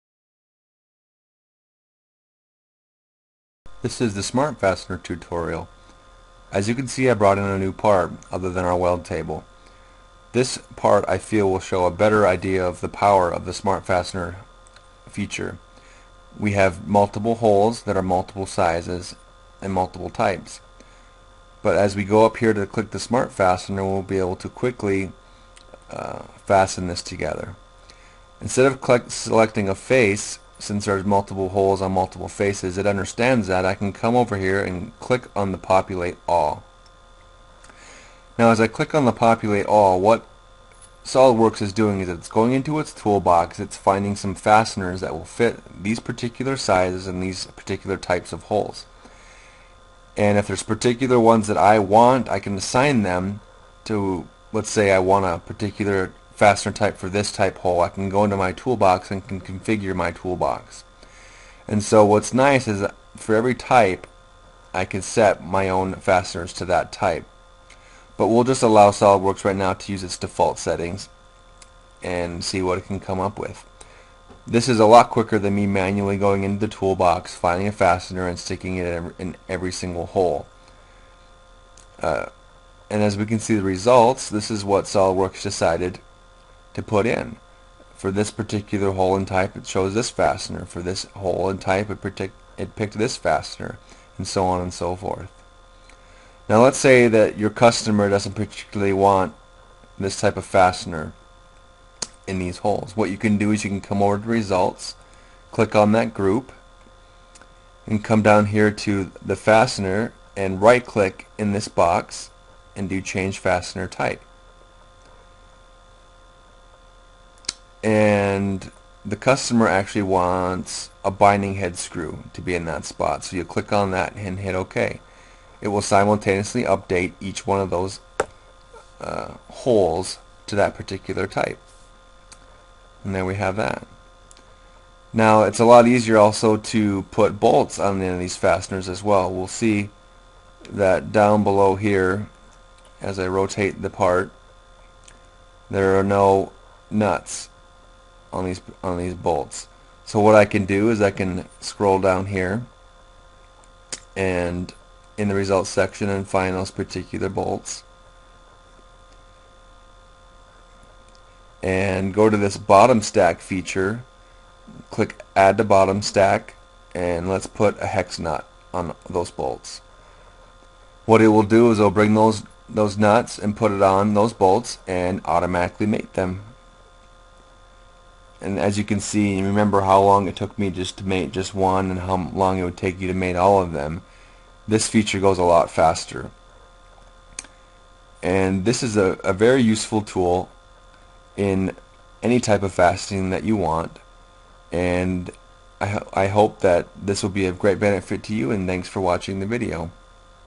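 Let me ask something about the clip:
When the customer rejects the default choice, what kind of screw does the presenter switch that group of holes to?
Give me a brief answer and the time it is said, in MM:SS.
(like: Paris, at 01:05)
Binding head screw, at 02:01.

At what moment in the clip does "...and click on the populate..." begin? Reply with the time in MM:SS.
00:34.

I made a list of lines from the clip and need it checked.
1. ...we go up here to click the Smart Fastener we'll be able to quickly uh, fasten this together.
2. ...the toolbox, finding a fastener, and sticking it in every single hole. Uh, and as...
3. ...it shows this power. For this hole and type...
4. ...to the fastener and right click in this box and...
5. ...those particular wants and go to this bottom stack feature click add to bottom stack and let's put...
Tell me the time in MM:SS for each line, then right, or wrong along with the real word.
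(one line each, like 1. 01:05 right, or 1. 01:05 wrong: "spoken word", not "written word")
1. 00:21 right
2. 01:16 right
3. 01:29 wrong: "fastener", not "power"
4. 01:48 right
5. 02:36 wrong: "bolts", not "wants".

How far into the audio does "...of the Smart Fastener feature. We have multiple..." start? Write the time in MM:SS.
00:13.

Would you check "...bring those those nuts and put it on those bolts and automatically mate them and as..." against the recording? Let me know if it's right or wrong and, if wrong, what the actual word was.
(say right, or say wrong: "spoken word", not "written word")
right.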